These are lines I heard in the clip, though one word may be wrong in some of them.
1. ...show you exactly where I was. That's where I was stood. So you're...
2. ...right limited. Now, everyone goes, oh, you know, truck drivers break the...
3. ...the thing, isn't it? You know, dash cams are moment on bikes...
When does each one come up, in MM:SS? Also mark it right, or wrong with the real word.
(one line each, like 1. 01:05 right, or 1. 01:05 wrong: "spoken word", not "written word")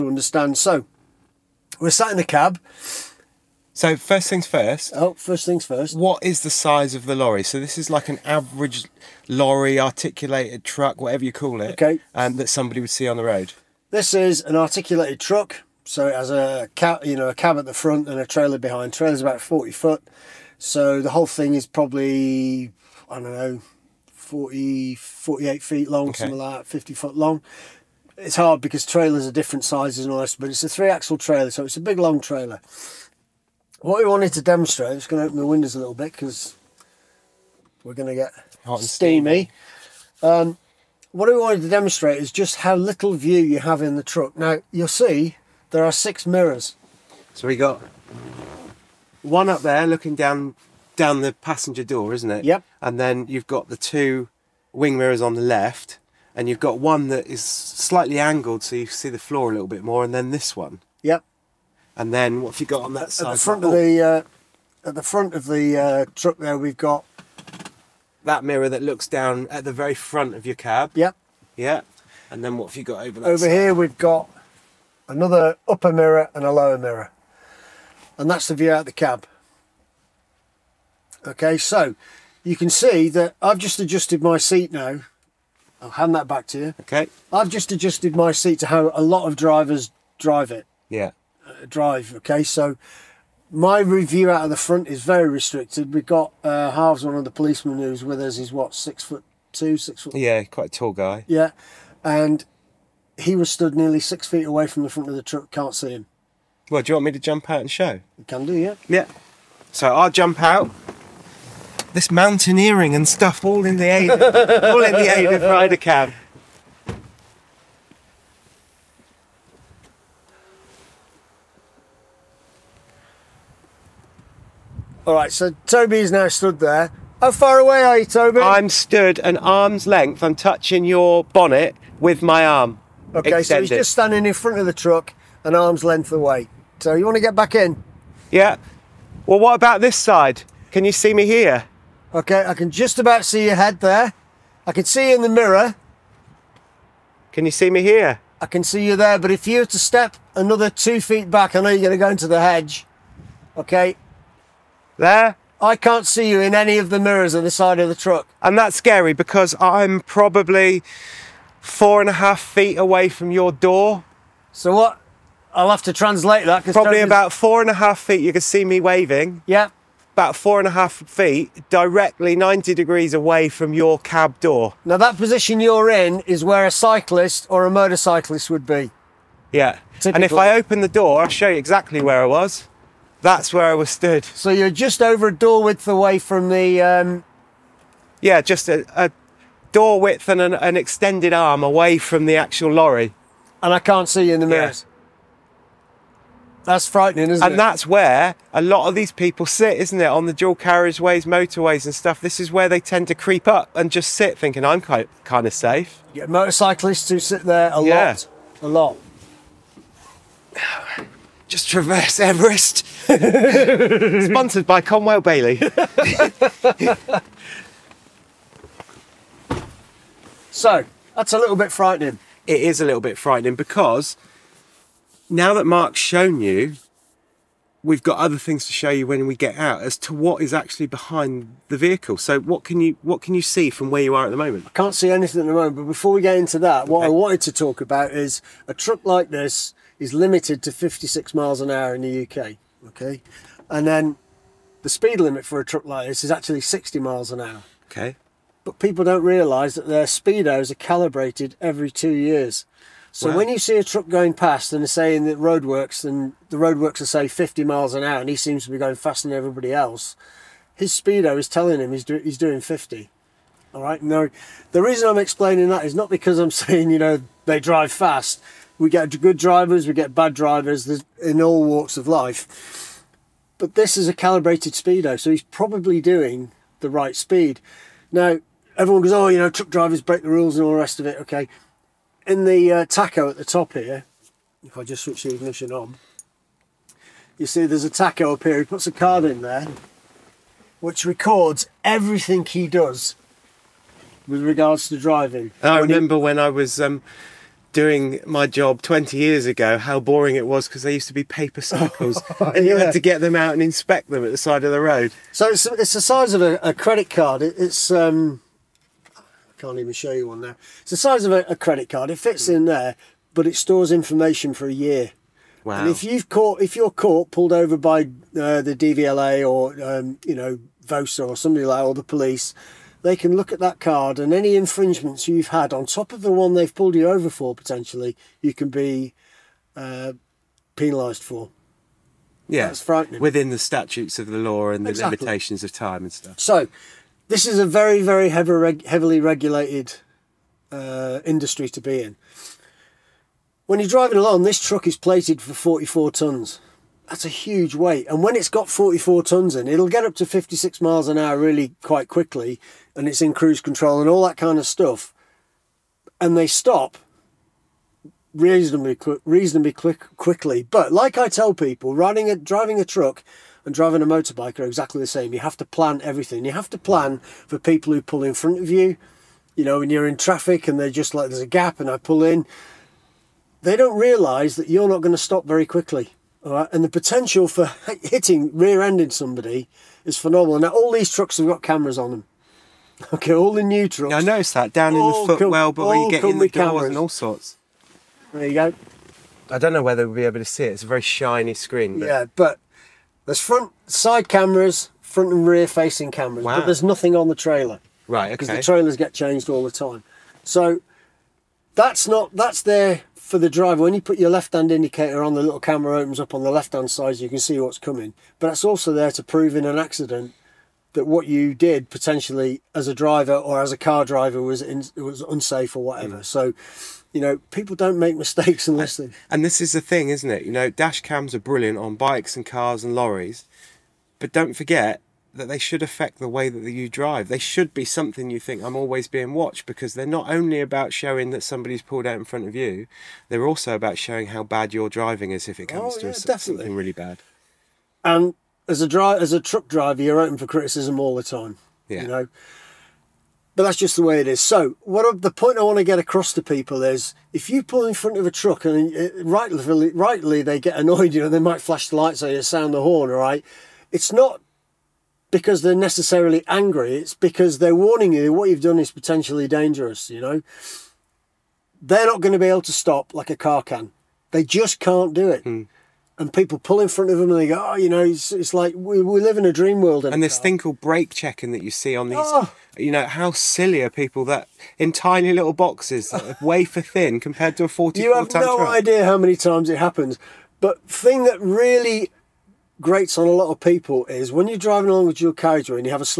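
1. 03:01 right
2. 04:36 wrong: "speed", not "limited"
3. 06:59 wrong: "brilliant", not "moment".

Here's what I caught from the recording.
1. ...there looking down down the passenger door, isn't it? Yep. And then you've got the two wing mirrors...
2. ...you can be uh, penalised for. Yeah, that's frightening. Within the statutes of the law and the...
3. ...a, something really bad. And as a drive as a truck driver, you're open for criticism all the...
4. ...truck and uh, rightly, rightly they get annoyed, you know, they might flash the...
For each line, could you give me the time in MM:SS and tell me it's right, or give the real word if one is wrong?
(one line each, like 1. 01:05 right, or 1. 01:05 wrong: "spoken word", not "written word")
1. 00:49 right
2. 05:28 right
3. 07:16 right
4. 07:28 right.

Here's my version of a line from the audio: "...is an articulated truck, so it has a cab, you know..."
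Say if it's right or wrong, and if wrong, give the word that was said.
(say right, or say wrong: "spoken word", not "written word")
right.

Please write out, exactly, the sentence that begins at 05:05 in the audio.
So it's, it's the size of a, a credit card.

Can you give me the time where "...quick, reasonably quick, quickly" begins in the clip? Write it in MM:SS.
05:58.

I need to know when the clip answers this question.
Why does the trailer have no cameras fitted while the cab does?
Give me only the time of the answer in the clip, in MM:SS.
06:38.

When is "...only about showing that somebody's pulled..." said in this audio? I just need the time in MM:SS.
07:10.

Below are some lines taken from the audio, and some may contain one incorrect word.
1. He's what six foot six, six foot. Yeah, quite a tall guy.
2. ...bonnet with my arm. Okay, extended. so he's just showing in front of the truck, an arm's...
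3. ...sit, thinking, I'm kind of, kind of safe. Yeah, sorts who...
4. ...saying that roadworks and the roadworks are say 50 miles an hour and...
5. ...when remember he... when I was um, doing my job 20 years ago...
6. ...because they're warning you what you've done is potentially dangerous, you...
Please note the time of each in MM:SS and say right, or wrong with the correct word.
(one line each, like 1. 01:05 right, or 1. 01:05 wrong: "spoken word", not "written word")
1. 01:38 wrong: "two", not "six"
2. 02:11 wrong: "standing", not "showing"
3. 03:24 wrong: "motorcyclists", not "sorts"
4. 04:14 right
5. 04:55 right
6. 07:37 right.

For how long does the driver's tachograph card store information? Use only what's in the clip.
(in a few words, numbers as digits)
A year.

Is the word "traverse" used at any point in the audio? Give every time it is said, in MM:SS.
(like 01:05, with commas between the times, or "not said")
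03:31.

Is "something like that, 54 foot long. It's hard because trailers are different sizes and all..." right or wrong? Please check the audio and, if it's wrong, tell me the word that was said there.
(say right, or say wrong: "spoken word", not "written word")
wrong: "50", not "54".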